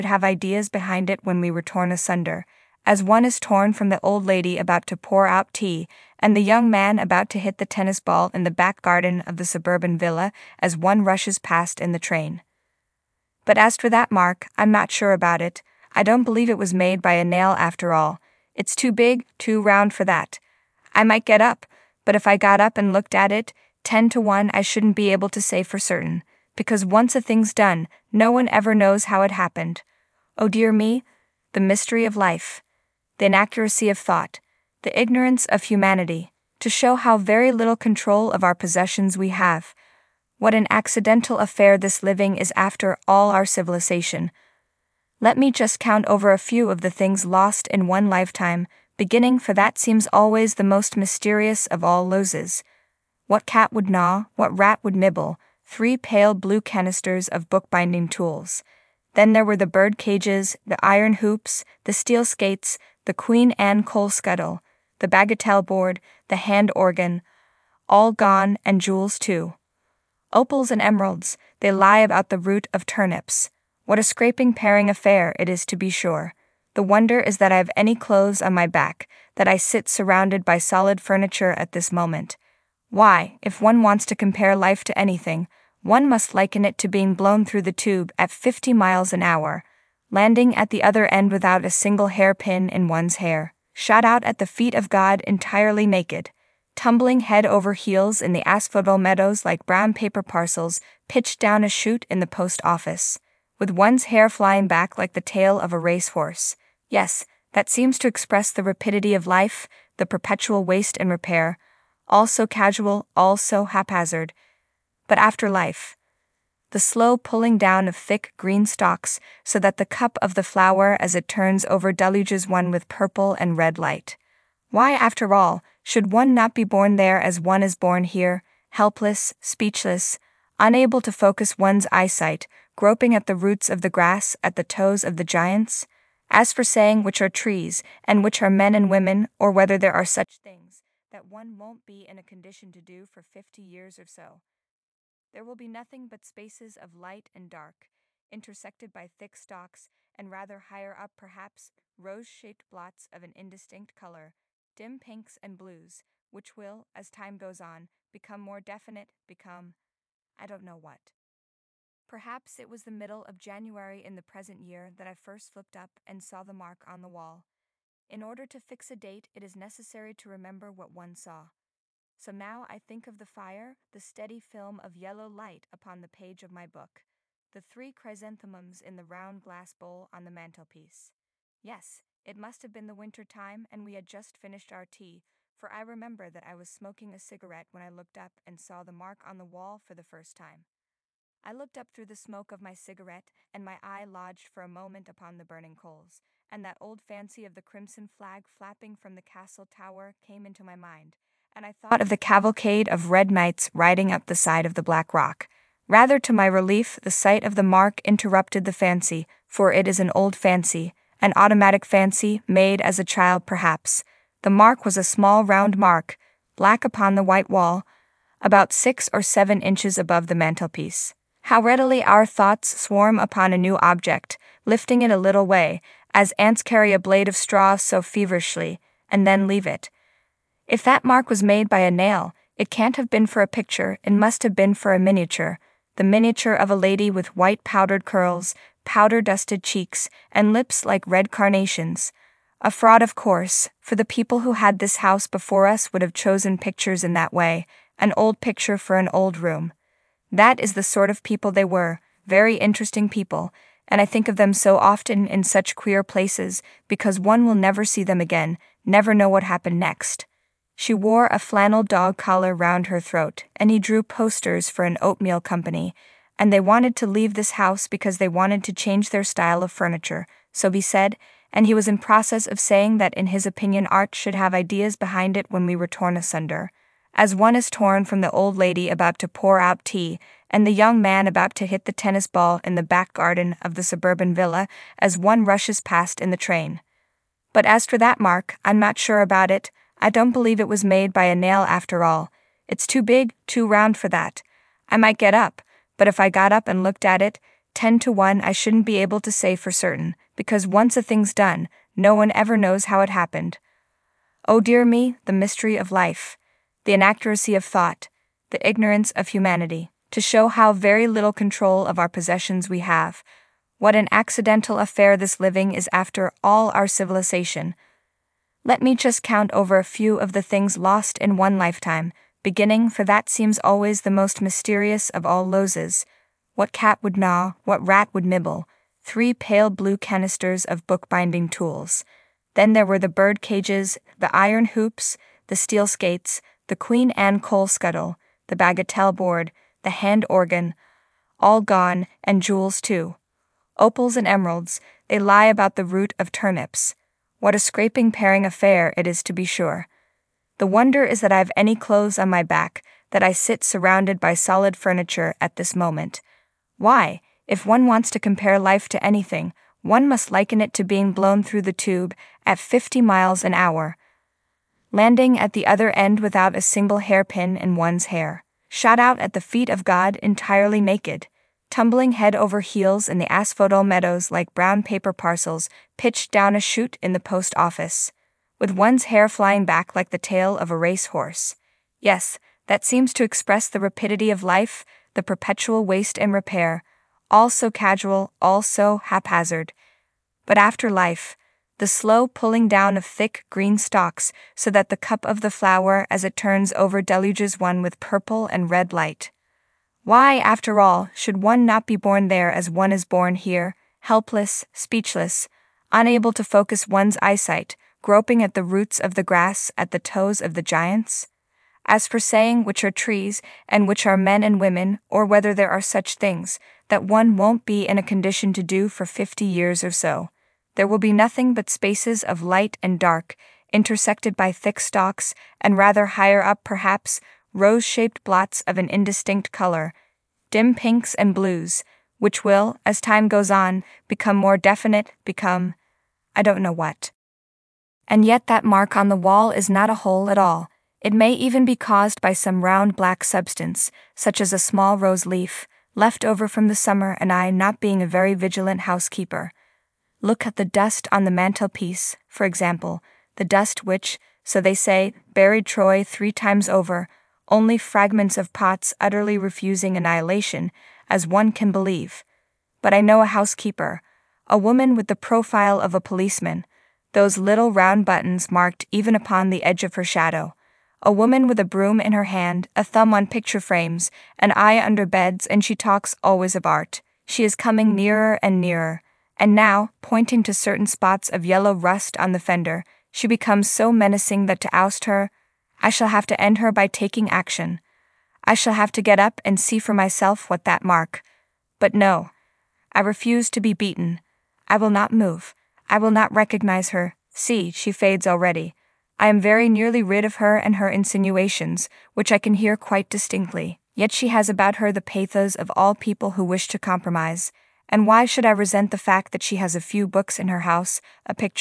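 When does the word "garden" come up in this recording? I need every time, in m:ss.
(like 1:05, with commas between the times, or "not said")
0:08, 4:43.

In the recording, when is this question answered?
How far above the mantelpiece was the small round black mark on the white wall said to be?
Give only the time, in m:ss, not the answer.
3:38.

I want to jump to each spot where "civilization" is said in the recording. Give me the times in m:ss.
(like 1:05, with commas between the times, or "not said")
0:43, 5:16.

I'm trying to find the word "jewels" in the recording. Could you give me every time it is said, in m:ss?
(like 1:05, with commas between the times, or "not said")
1:08, 5:42.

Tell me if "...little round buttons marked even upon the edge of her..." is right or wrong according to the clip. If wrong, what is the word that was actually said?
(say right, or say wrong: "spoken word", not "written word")
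right.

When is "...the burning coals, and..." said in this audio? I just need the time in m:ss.
3:15.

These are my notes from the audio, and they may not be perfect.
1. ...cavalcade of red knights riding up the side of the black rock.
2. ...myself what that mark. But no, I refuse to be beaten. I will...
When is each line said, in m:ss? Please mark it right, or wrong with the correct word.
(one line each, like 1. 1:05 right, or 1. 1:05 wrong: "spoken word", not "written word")
1. 3:22 right
2. 8:09 right.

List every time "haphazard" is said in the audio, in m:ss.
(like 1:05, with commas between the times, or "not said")
1:53, 6:29.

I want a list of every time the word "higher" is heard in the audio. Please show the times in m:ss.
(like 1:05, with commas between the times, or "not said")
2:30, 7:06.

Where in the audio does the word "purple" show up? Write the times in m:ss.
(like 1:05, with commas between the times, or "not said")
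2:02, 6:38.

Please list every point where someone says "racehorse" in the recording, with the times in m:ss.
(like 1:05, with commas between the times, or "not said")
1:45, 6:20.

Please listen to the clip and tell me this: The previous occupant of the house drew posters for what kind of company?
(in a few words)
An oatmeal company.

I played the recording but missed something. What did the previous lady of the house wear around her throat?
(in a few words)
A flannel dog collar.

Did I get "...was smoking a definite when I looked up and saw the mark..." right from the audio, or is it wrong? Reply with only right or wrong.
wrong.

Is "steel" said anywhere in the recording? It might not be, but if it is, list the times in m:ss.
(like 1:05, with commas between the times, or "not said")
1:01, 5:35.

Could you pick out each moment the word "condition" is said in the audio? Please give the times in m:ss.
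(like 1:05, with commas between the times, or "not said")
2:22, 6:58.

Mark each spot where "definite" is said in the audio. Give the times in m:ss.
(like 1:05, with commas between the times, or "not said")
2:38, 7:14.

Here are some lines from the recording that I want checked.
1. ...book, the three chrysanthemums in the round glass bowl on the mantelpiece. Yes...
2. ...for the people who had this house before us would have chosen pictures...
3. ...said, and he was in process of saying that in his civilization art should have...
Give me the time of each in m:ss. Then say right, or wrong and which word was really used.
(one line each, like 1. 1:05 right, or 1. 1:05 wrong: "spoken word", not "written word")
1. 2:56 right
2. 4:03 right
3. 4:30 wrong: "opinion", not "civilization".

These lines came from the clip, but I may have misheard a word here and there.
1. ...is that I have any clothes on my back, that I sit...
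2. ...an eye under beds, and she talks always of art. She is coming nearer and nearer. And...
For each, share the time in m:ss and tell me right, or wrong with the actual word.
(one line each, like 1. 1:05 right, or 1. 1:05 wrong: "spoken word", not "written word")
1. 1:17 right
2. 7:54 right.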